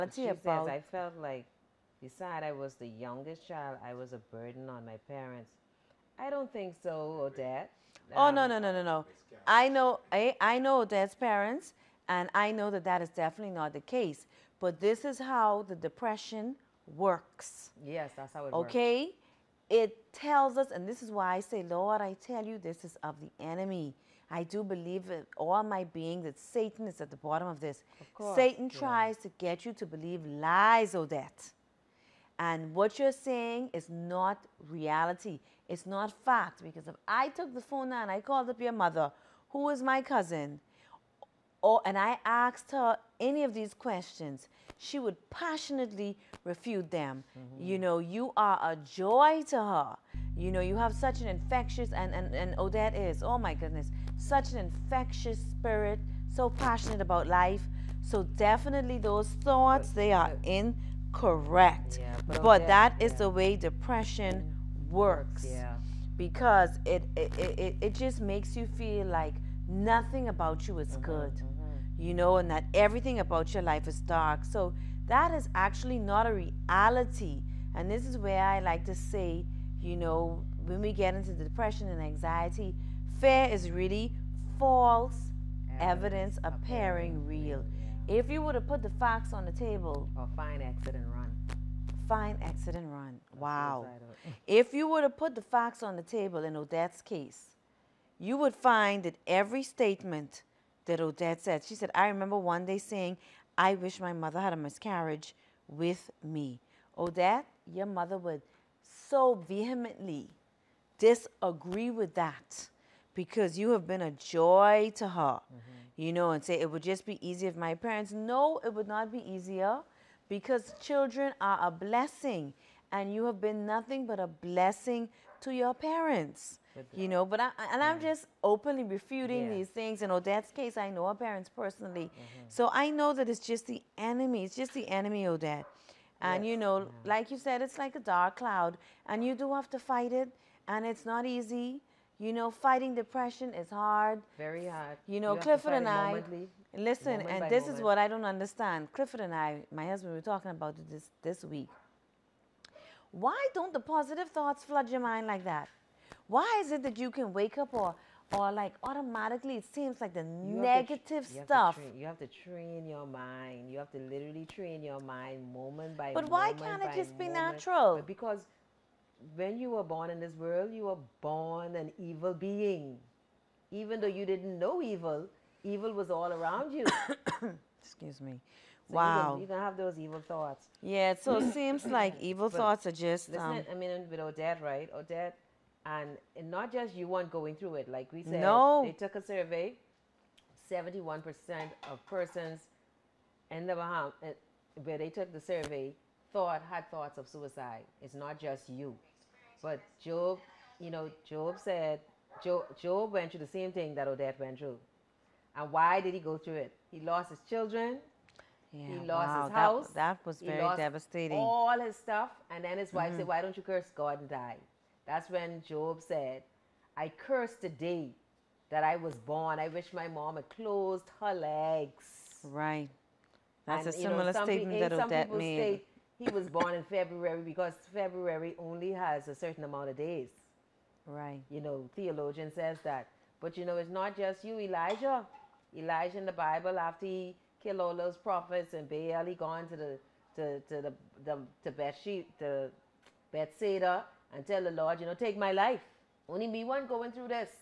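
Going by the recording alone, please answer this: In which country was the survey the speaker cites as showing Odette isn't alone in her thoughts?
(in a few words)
The Bahamas.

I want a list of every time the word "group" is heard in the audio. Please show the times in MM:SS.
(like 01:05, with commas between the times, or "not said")
not said.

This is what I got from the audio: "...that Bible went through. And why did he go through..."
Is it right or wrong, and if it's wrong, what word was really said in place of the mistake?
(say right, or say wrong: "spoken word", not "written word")
wrong: "Odette", not "Bible".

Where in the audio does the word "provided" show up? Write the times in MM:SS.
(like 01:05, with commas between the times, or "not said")
not said.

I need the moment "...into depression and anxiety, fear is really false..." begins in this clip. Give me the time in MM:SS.
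01:21.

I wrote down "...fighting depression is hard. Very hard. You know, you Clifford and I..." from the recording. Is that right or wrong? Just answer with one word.
right.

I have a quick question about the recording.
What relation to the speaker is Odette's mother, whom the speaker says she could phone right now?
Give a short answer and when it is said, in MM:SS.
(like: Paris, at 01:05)
Cousin, at 00:40.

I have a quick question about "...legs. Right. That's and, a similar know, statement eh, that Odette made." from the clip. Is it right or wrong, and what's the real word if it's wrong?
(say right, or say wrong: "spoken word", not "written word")
right.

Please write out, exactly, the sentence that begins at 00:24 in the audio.
I do believe with all my being that Satan is at the bottom of this.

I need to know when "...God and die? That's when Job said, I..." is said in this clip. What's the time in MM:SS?
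03:33.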